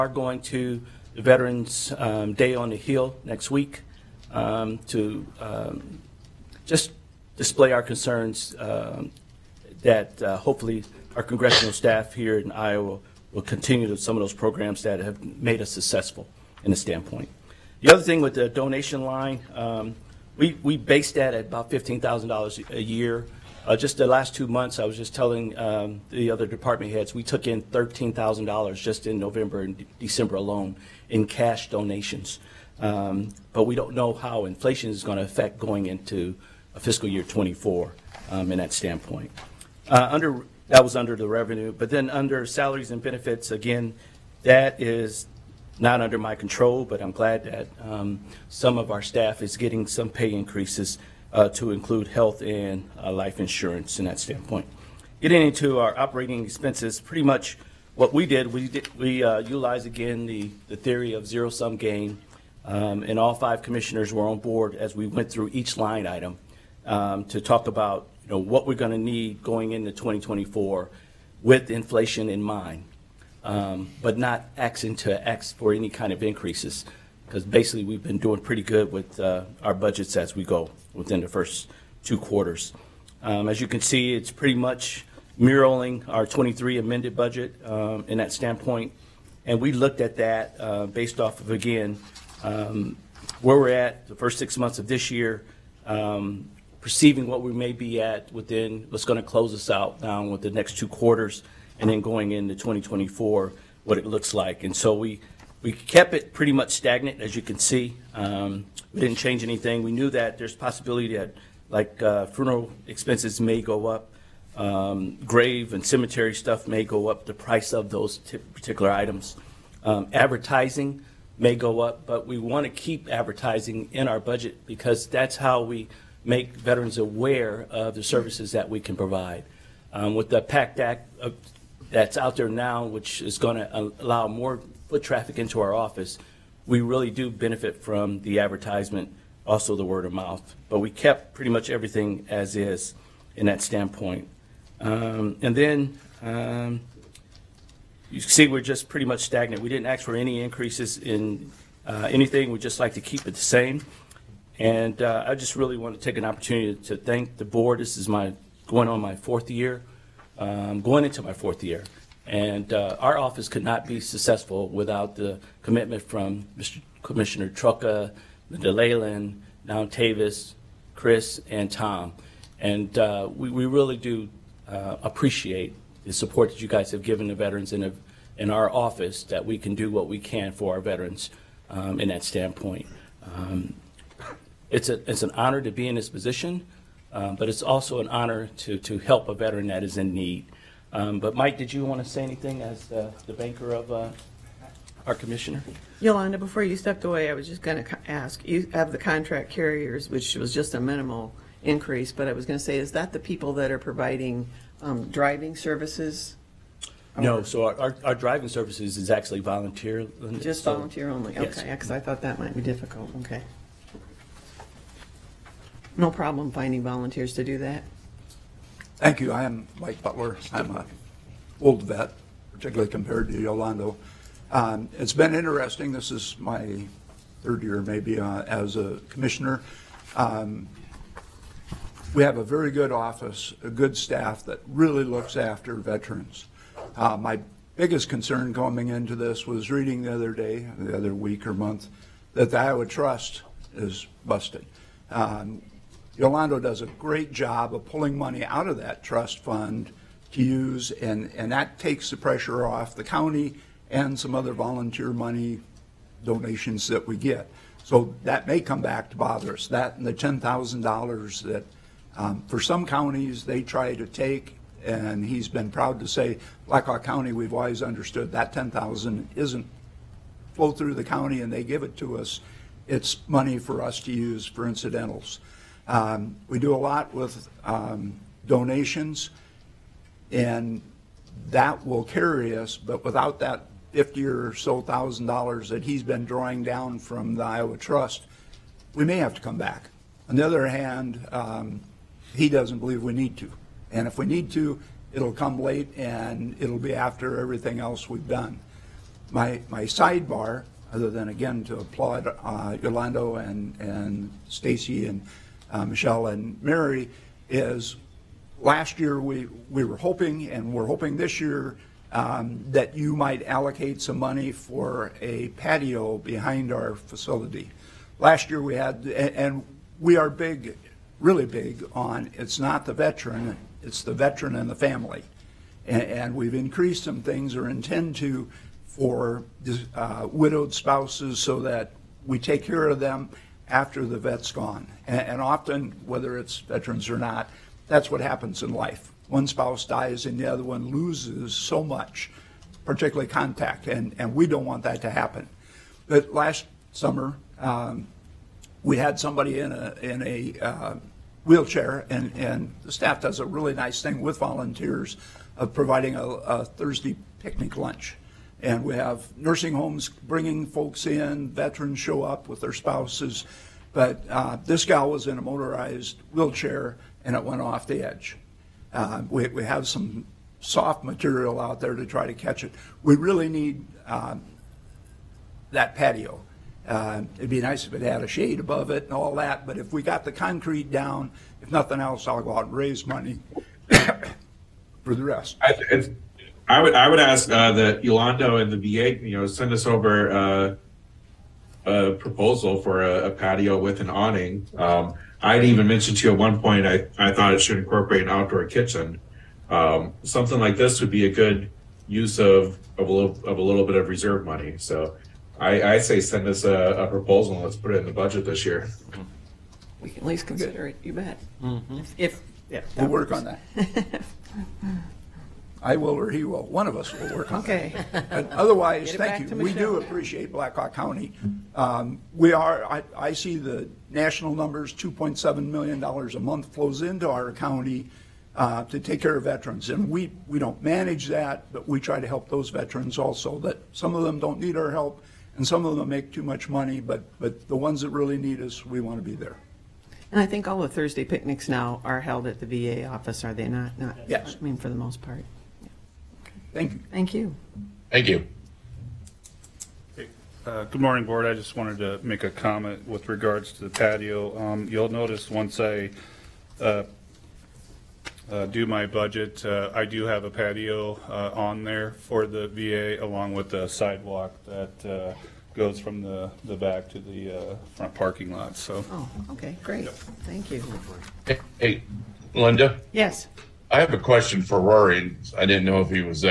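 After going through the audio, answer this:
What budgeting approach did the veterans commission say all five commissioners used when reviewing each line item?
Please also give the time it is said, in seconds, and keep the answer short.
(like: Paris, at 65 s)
zero sum gain, at 61 s.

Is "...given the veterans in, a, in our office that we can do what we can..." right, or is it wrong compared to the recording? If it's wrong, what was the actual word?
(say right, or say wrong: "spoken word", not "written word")
right.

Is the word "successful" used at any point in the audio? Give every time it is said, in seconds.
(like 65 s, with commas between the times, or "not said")
15 s, 164 s.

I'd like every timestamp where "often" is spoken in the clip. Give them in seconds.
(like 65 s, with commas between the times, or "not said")
335 s.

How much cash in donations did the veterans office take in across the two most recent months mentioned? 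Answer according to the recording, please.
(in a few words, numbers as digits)
$13,000.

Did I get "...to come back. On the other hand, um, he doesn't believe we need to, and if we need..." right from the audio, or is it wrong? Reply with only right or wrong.
right.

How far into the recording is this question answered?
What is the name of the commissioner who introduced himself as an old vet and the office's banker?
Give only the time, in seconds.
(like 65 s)
219 s.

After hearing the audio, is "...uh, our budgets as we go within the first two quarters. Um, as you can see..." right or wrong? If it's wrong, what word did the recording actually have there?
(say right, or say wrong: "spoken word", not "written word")
right.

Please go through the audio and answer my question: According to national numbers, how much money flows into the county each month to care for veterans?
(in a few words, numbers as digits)
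$2.7 million.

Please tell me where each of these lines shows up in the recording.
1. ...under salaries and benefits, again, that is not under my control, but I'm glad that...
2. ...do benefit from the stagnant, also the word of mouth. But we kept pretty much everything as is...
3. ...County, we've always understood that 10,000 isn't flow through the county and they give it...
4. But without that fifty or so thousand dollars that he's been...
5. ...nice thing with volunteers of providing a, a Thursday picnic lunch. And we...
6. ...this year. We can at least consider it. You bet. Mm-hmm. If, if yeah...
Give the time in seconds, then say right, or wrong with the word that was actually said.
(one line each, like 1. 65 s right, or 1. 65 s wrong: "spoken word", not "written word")
1. 42 s right
2. 137 s wrong: "advertisement", not "stagnant"
3. 267 s right
4. 282 s right
5. 353 s right
6. 408 s right.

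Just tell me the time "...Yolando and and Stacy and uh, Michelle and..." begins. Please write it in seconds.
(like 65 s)
302 s.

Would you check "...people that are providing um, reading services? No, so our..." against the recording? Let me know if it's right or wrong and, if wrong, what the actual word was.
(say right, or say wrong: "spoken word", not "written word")
wrong: "driving", not "reading".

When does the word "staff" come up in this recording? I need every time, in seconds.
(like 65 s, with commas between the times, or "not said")
11 s, 49 s, 233 s, 352 s.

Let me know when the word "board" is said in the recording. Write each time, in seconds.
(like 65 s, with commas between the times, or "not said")
64 s, 157 s, 451 s.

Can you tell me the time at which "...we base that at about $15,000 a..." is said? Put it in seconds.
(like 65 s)
20 s.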